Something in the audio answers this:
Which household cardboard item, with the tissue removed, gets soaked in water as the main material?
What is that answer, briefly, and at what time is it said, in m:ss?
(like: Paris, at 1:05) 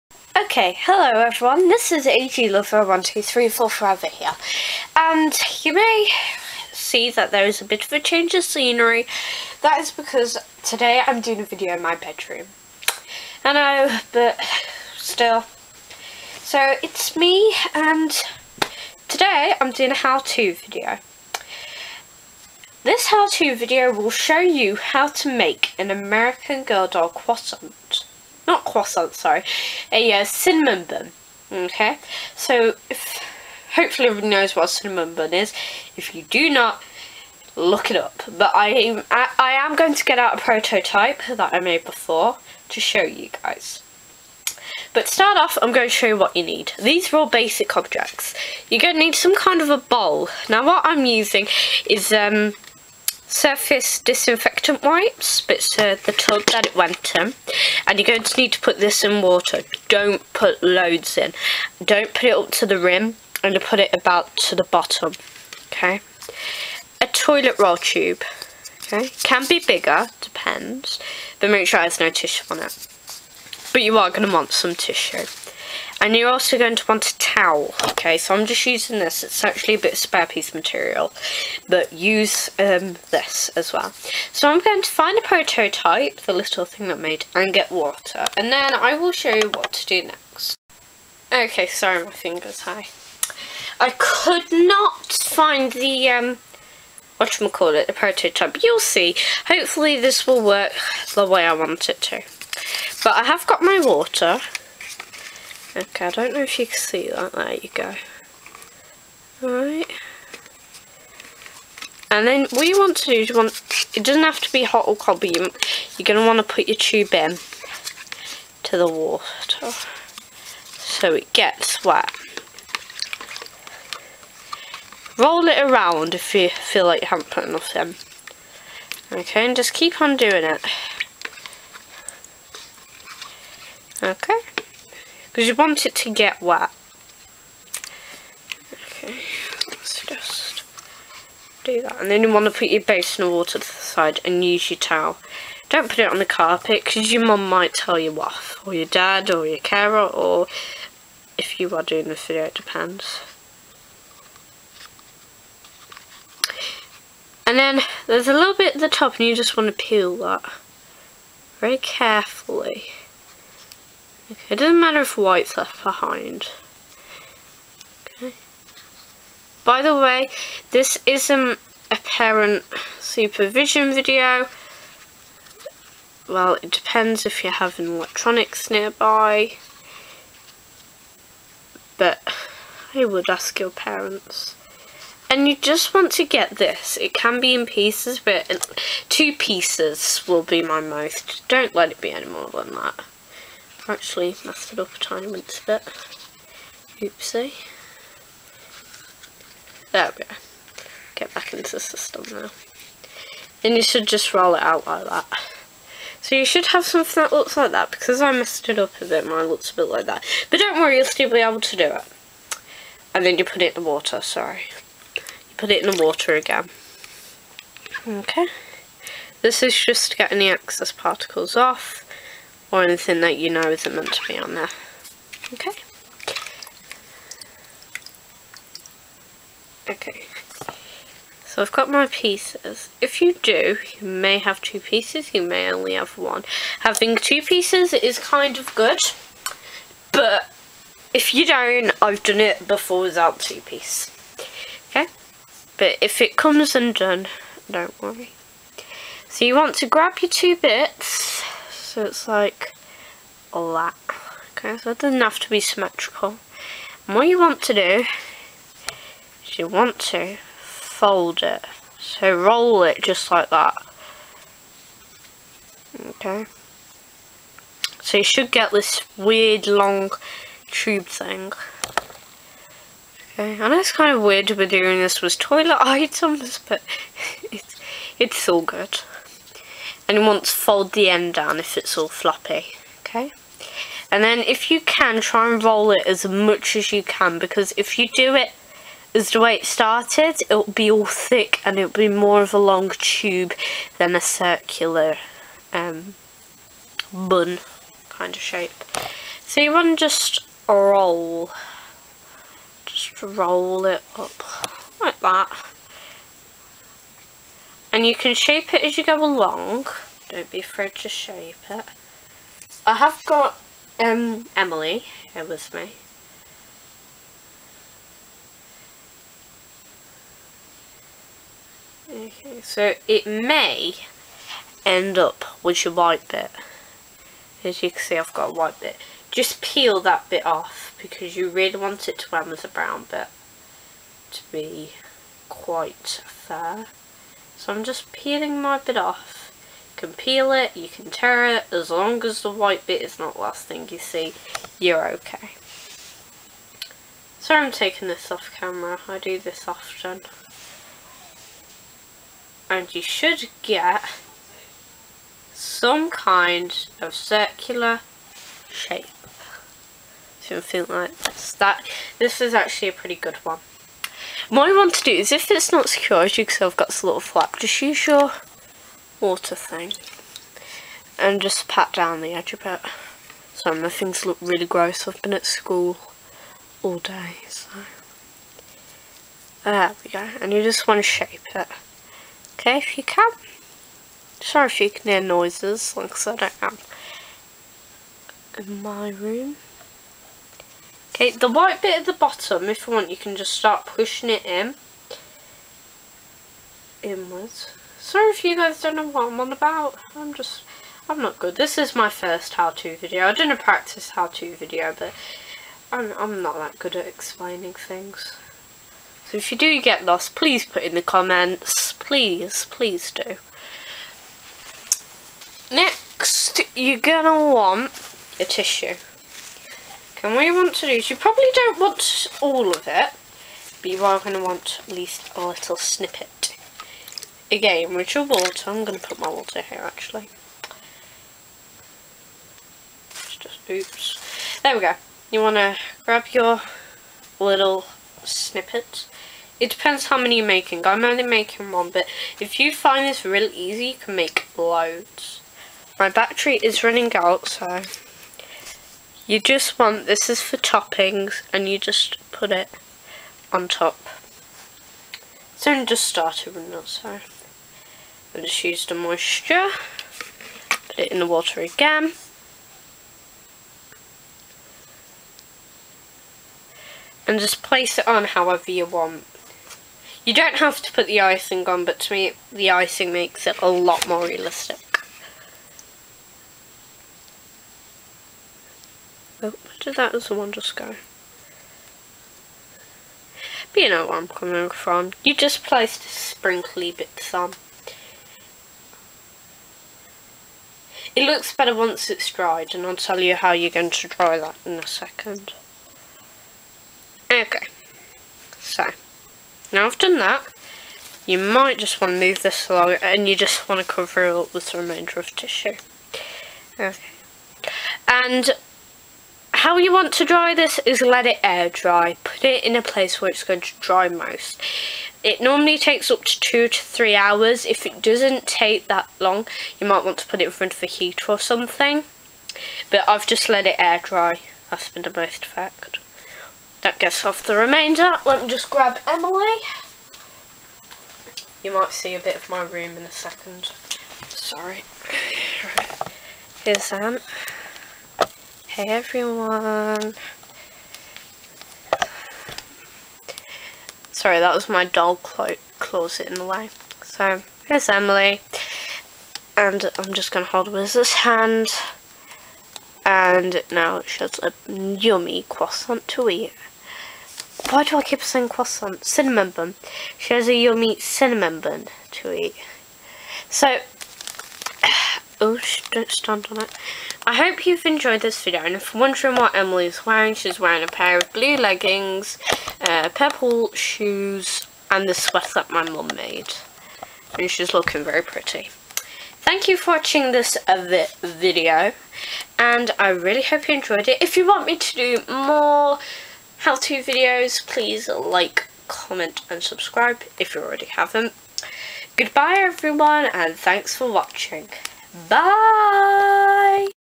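Toilet roll tube, at 1:07.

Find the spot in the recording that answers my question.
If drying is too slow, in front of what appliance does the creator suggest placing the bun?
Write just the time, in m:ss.
8:40.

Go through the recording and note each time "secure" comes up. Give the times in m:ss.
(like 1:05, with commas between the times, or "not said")
6:05.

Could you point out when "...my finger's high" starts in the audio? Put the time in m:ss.
1:32.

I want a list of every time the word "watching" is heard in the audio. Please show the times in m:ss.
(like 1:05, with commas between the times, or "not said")
9:39, 9:54.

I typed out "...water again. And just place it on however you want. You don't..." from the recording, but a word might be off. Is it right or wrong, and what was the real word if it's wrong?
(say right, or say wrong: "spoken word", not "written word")
right.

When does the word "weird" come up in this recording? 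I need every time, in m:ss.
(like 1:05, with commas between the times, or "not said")
4:29, 4:34.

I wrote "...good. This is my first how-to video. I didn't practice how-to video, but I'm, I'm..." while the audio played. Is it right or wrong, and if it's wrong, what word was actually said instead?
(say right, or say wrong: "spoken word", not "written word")
right.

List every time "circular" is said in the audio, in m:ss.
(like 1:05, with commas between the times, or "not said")
4:54, 5:57.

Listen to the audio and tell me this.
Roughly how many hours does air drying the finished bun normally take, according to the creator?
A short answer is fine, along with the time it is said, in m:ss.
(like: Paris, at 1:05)
2 to 3 hours, at 8:36.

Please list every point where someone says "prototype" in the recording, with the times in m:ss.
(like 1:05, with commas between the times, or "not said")
0:40, 1:25, 1:37.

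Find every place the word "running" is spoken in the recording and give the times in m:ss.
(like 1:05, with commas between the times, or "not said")
7:26, 7:36.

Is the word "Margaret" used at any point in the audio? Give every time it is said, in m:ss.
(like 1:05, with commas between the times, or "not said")
not said.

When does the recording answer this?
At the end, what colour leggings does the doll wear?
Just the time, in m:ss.
9:31.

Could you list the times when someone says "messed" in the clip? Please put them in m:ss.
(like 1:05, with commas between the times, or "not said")
3:14, 3:28.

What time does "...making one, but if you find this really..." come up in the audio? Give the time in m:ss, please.
7:21.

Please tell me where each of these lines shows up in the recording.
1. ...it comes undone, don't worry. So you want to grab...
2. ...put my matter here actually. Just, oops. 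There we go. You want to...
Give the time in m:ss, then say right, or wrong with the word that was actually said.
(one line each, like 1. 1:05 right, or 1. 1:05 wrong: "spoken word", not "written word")
1. 4:06 right
2. 7:09 wrong: "water", not "matter".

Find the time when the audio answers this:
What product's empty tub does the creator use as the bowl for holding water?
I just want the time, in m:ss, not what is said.
0:53.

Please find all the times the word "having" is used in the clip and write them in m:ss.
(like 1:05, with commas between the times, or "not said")
2:57, 3:56.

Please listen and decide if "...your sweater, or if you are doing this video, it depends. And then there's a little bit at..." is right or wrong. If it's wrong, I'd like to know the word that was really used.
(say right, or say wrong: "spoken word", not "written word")
wrong: "carer", not "sweater".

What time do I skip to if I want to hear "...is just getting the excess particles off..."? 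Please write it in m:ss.
3:39.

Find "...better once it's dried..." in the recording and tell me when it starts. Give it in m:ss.
8:11.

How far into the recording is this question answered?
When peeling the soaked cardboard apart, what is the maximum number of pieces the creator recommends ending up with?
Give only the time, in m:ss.
3:09.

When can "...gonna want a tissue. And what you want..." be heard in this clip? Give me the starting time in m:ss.
6:56.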